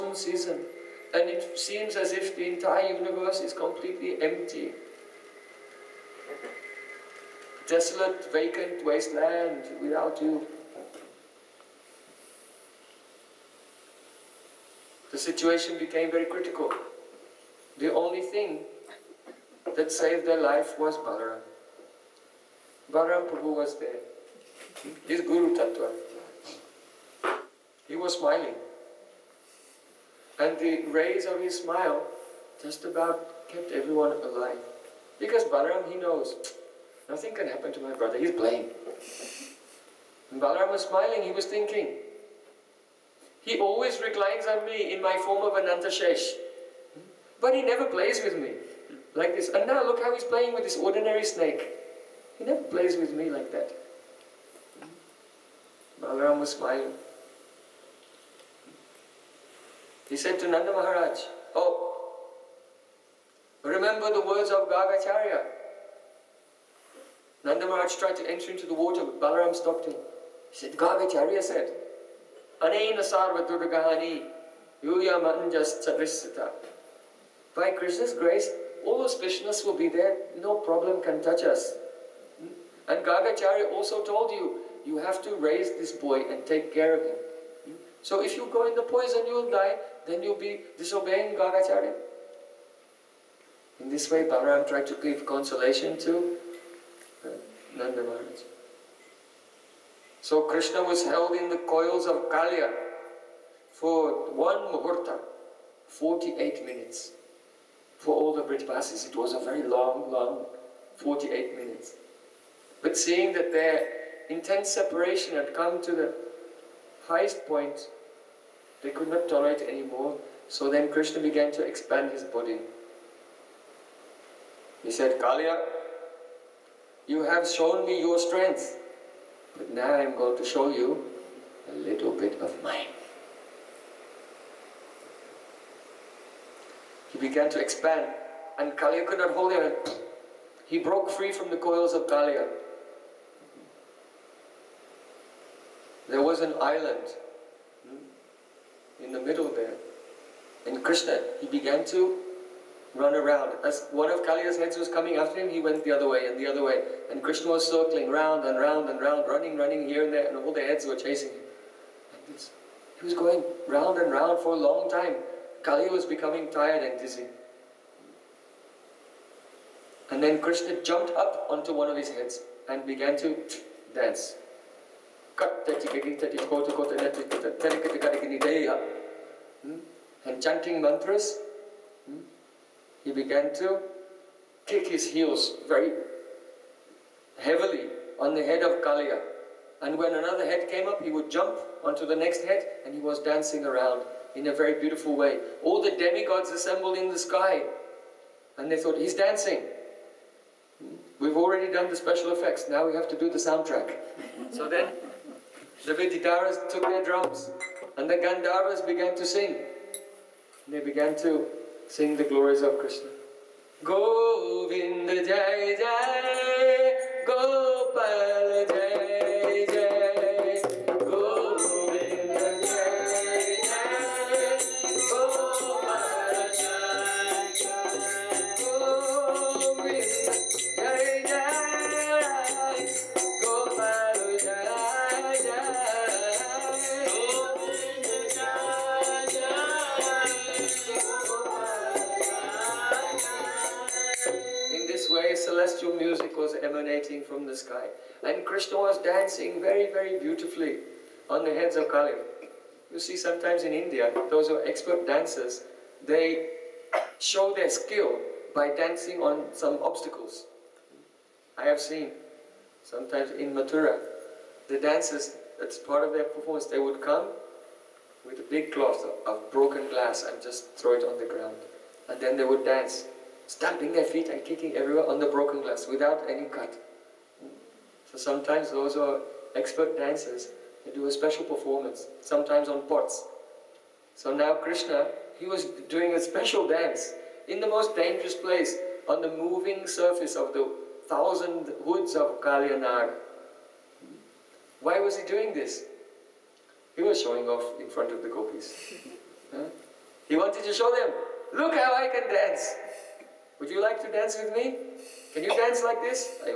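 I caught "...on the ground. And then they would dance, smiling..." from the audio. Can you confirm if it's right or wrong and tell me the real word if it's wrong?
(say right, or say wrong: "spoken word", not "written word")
wrong: "stamping", not "smiling".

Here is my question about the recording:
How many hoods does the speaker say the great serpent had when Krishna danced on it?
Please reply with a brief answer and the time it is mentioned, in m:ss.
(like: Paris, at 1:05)
1000, at 4:51.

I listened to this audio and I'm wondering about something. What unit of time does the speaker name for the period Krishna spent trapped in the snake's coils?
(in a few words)
muhurta.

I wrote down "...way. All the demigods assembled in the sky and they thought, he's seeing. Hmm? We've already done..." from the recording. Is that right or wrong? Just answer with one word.
wrong.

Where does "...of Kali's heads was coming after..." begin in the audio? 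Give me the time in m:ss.
2:34.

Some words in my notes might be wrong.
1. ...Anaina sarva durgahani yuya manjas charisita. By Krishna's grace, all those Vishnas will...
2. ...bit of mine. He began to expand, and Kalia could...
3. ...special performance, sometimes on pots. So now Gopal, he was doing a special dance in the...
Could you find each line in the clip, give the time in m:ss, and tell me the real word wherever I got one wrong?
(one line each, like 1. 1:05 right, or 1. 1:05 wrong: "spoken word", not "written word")
1. 1:12 right
2. 2:12 right
3. 4:41 wrong: "Krishna", not "Gopal".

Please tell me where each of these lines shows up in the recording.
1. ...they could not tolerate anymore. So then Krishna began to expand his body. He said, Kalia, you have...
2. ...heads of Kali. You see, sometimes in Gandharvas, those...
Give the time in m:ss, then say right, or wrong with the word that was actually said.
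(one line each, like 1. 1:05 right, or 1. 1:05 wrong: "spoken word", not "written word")
1. 1:58 right
2. 4:11 wrong: "India", not "Gandharvas".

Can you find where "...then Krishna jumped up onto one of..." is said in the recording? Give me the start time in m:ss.
2:50.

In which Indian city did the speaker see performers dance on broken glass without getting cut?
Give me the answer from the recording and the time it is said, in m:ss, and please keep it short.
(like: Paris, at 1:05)
Mathura, at 4:23.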